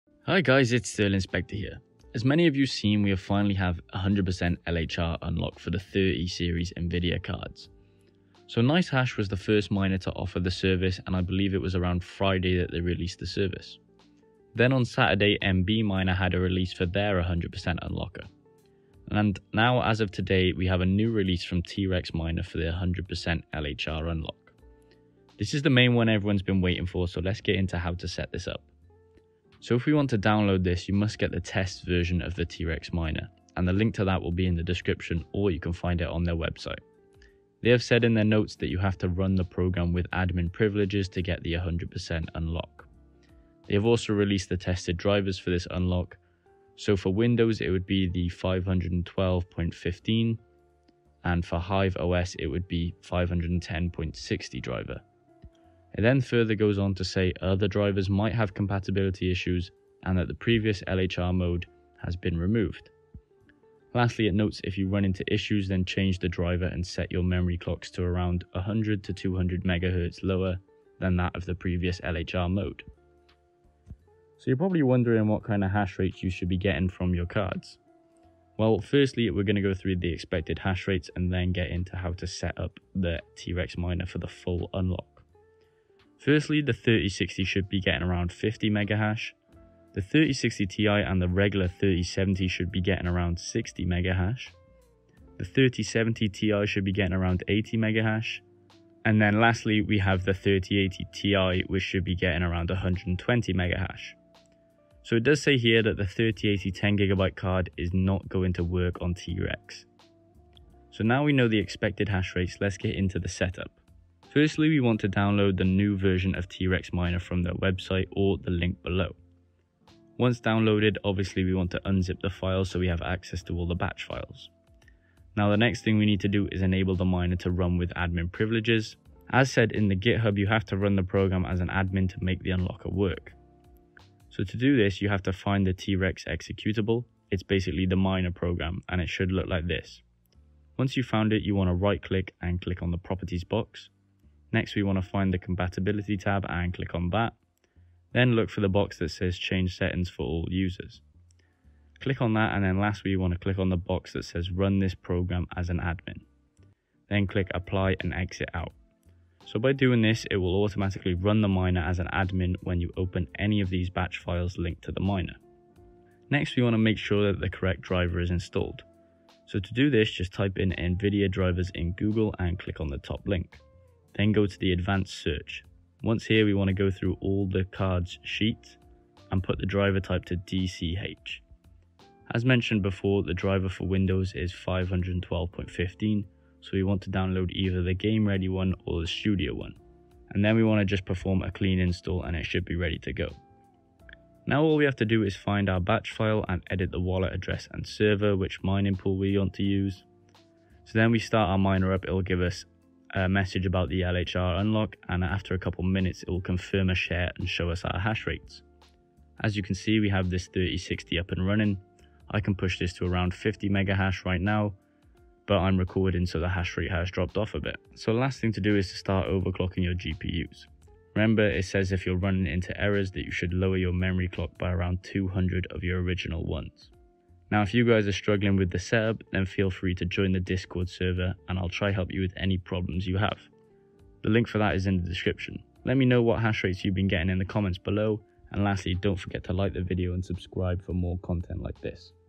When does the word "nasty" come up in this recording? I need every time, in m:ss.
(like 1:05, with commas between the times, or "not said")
not said.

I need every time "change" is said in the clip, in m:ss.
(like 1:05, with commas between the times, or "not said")
1:05, 2:29.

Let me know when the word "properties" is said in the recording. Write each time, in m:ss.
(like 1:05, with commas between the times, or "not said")
2:22.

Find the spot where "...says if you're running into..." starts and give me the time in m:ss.
3:41.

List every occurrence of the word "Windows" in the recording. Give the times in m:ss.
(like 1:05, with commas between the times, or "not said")
0:47, 3:03.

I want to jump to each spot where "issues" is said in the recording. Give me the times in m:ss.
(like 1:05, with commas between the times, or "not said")
0:59, 1:05.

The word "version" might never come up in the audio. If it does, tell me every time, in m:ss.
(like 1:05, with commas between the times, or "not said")
0:31, 1:55.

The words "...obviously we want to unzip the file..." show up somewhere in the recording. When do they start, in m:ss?
2:01.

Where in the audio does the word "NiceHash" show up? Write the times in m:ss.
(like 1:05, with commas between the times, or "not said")
0:08.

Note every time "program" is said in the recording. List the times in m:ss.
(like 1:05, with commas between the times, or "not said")
0:39, 2:11, 2:18, 2:34.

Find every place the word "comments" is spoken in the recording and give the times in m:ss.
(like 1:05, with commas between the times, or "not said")
3:57.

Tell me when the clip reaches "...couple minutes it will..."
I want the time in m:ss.
3:25.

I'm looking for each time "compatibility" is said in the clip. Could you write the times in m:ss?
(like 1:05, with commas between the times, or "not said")
0:58, 2:25.